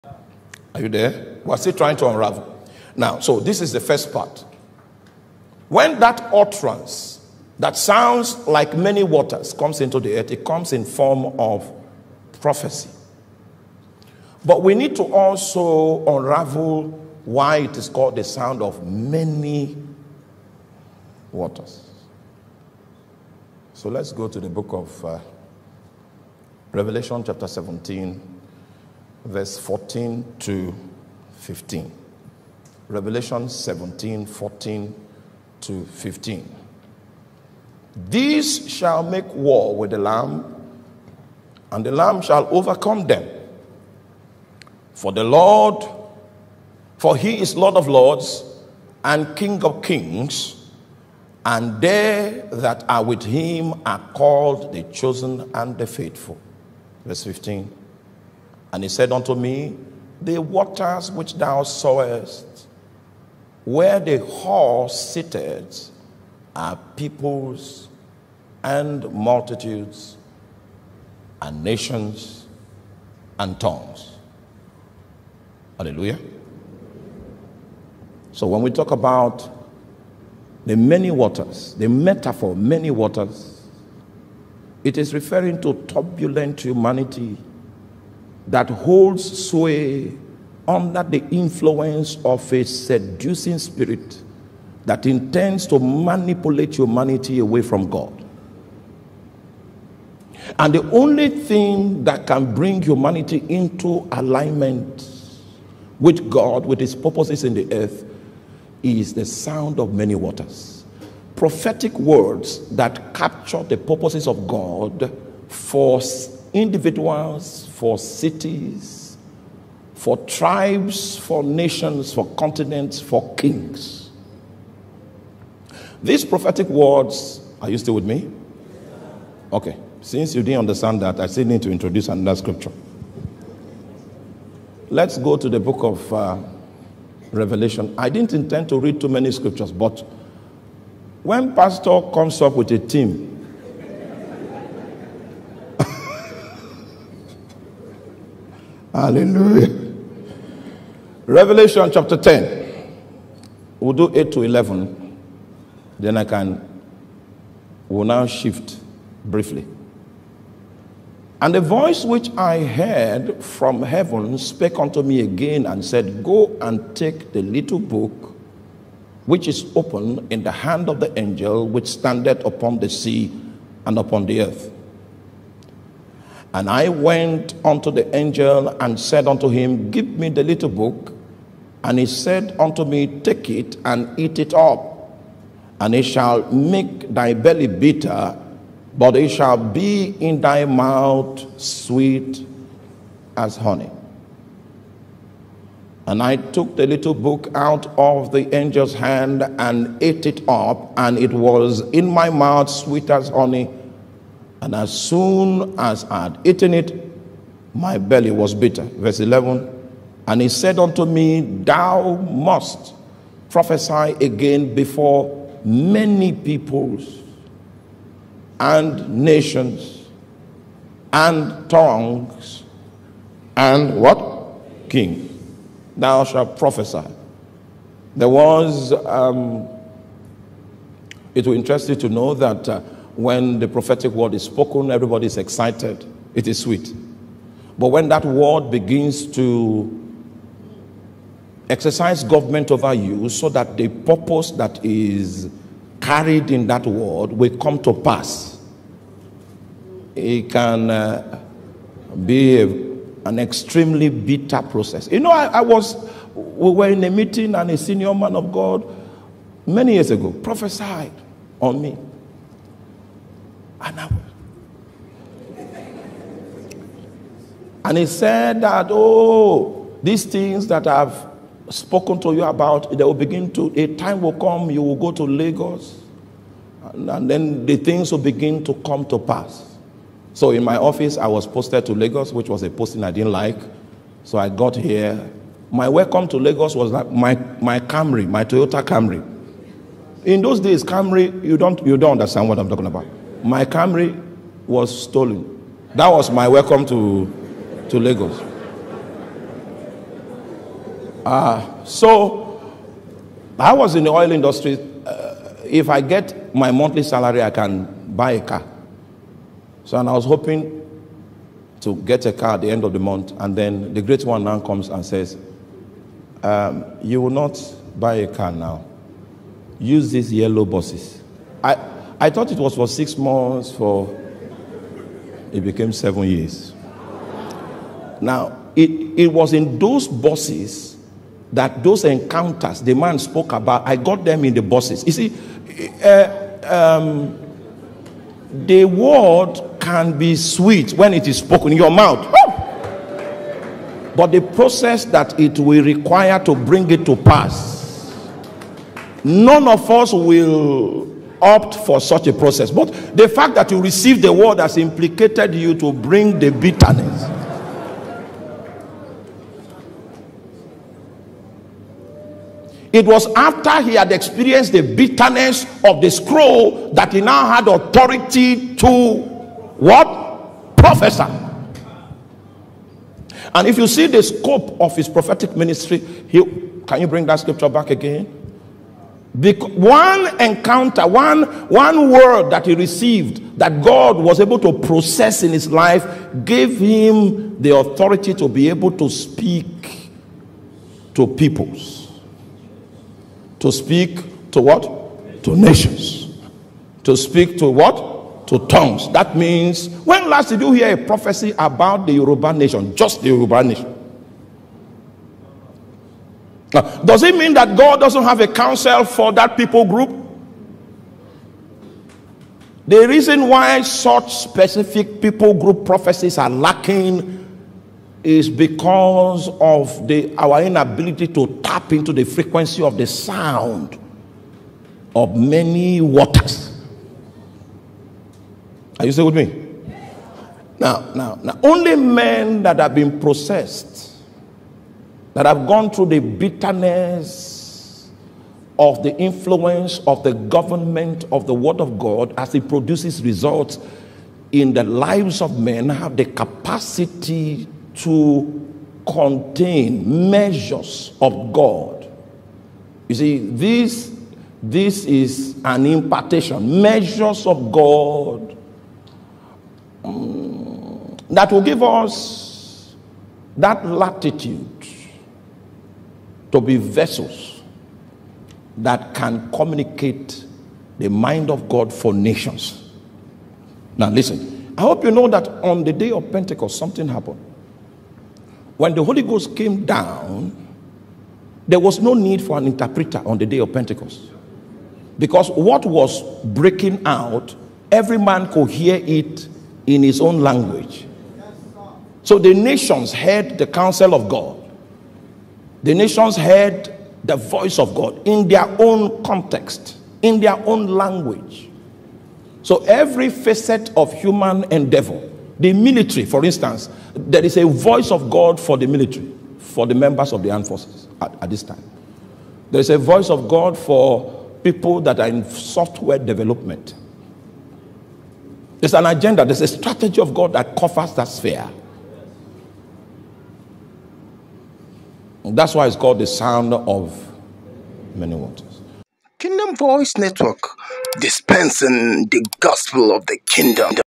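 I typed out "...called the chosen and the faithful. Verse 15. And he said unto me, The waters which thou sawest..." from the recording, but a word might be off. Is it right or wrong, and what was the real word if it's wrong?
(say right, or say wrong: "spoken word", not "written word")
right.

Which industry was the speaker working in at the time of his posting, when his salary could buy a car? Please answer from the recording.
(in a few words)
oil industry.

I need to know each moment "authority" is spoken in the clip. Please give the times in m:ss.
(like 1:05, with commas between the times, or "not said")
6:07, 6:27.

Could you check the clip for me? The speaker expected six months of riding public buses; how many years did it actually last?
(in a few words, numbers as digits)
7.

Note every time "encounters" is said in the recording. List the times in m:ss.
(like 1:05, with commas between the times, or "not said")
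5:32, 6:20.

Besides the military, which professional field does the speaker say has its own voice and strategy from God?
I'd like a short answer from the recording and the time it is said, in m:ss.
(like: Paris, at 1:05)
software development, at 8:35.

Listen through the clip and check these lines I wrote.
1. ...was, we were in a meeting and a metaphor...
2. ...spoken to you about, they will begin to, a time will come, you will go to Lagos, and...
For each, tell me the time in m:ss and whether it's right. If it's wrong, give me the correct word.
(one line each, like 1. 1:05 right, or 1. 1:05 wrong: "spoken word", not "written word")
1. 4:15 wrong: "senior", not "metaphor"
2. 4:31 right.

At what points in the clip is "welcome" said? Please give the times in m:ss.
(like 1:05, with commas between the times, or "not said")
4:45, 4:56.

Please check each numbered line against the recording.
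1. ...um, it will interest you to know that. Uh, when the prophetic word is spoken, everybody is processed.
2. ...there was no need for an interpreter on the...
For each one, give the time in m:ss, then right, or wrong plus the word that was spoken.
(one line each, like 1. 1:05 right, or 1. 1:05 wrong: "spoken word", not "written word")
1. 3:48 wrong: "excited", not "processed"
2. 8:01 right.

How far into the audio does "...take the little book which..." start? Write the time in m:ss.
2:46.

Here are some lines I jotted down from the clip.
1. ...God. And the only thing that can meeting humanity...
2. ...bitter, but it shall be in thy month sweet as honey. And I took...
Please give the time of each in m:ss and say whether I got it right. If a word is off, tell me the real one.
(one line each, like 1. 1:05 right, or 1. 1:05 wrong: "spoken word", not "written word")
1. 1:37 wrong: "bring", not "meeting"
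2. 3:07 wrong: "mouth", not "month".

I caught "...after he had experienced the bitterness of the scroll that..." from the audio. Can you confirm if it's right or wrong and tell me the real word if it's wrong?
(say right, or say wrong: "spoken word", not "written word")
right.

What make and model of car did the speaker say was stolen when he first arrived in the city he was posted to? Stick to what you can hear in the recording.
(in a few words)
Toyota Camry.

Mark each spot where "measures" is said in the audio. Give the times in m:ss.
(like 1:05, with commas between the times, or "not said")
7:30, 7:36.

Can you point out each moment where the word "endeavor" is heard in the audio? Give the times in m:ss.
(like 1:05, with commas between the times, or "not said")
8:24.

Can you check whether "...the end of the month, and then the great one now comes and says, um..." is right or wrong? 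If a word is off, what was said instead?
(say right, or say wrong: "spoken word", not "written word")
right.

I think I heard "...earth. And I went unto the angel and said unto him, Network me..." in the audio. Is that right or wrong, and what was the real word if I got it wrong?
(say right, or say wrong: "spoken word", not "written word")
wrong: "Give", not "Network".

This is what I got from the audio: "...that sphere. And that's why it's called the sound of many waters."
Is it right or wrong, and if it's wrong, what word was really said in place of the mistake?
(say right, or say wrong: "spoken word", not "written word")
right.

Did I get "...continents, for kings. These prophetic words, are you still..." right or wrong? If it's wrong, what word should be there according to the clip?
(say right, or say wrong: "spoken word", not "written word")
right.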